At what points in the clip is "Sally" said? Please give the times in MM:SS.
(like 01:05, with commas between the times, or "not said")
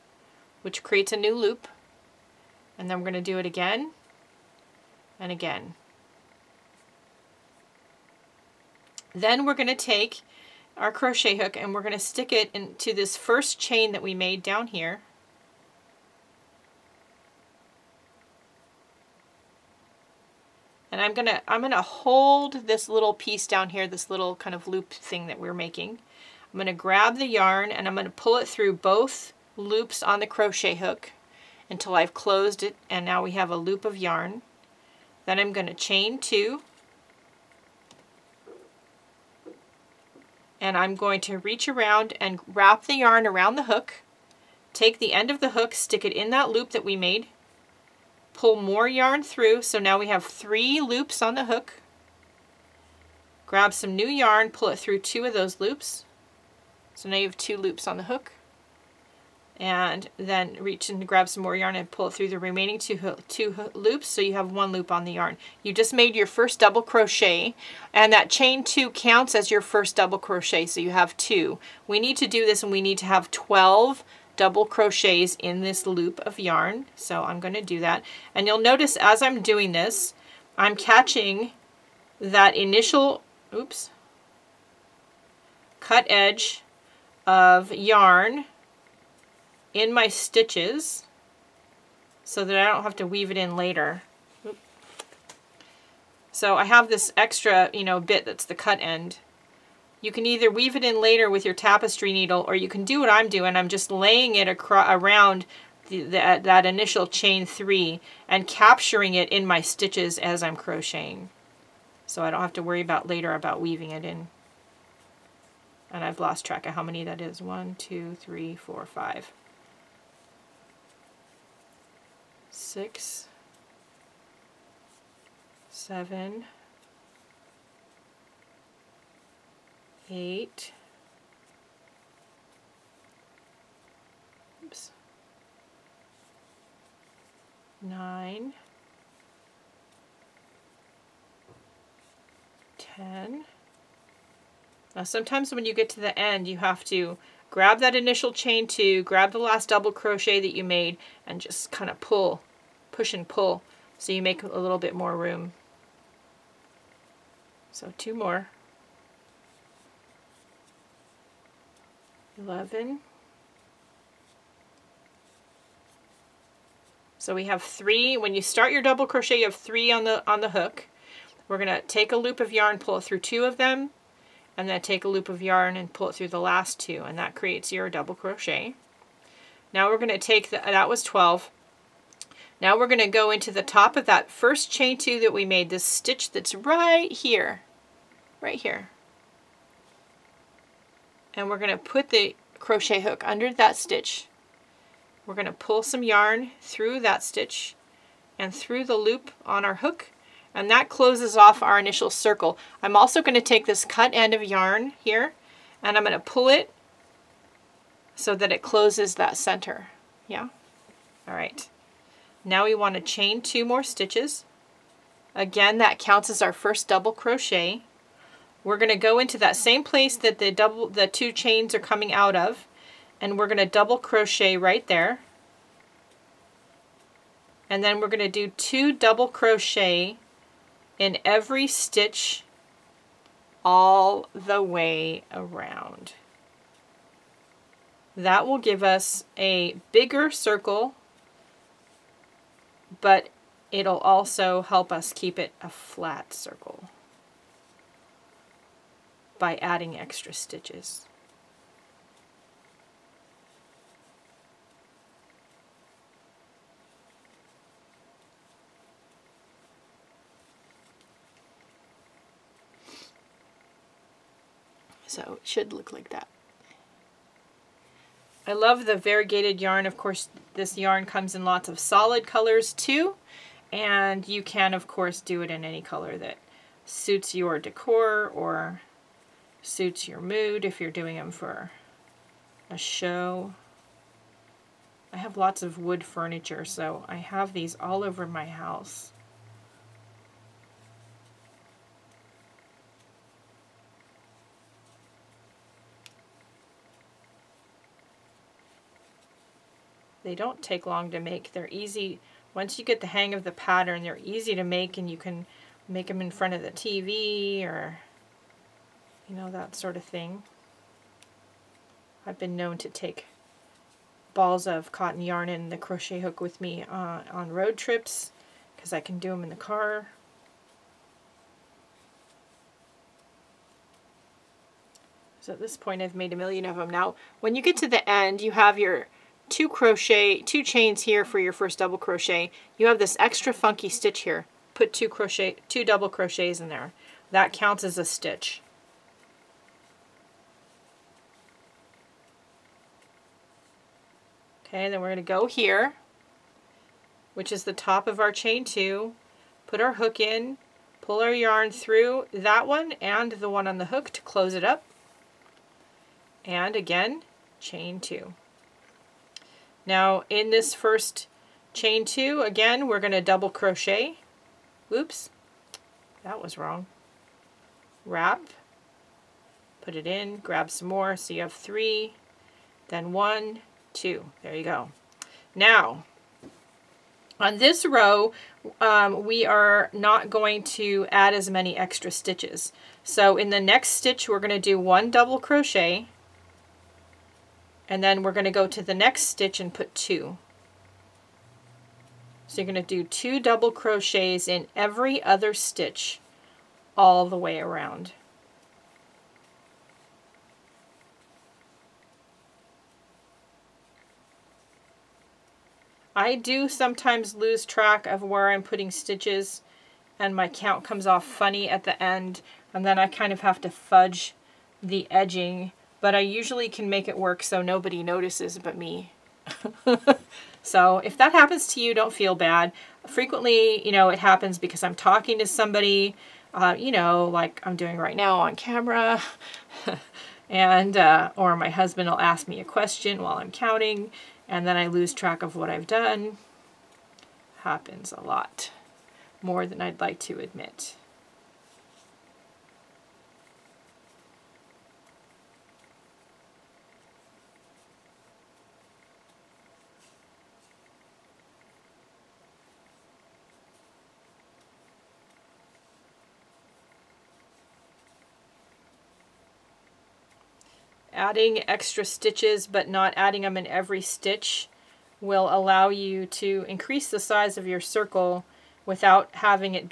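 not said.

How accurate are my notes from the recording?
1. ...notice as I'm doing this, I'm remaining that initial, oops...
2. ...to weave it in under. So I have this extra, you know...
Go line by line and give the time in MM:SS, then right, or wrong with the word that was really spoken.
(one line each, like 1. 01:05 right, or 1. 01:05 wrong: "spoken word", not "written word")
1. 01:18 wrong: "catching", not "remaining"
2. 01:32 wrong: "later", not "under".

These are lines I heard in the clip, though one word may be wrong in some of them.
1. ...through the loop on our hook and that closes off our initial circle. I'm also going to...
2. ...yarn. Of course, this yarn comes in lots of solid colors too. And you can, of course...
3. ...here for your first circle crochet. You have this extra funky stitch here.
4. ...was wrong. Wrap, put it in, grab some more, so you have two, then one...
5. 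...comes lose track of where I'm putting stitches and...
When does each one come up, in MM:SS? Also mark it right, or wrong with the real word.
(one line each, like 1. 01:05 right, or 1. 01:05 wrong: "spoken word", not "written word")
1. 03:18 right
2. 04:29 right
3. 05:31 wrong: "double", not "circle"
4. 06:06 wrong: "three", not "two"
5. 06:46 wrong: "sometimes", not "comes".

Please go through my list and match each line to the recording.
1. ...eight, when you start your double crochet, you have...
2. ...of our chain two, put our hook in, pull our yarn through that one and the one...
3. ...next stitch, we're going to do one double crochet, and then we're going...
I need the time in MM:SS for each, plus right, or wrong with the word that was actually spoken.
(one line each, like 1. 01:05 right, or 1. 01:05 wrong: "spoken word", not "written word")
1. 02:47 wrong: "three", not "eight"
2. 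05:48 right
3. 06:23 right.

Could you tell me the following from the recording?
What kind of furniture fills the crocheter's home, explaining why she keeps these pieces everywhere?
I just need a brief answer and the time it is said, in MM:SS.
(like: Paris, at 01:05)
wood furniture, at 04:45.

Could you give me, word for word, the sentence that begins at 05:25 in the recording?
So at this point I've made a million of them.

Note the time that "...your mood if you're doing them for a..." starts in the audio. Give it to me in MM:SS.
04:40.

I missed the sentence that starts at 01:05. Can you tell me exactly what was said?
You just made your first double crochet and that chain two counts as your first double crochet so you have two.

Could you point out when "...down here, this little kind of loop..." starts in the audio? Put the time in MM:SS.
00:23.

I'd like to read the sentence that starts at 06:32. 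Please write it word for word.
So you're going to do two double crochets in every other stitch all the way around.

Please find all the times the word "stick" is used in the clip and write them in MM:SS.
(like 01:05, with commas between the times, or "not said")
00:11, 00:45.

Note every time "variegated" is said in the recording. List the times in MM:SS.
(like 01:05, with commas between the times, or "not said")
04:28.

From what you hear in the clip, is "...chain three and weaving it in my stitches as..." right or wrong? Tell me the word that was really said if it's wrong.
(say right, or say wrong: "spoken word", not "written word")
wrong: "capturing", not "weaving".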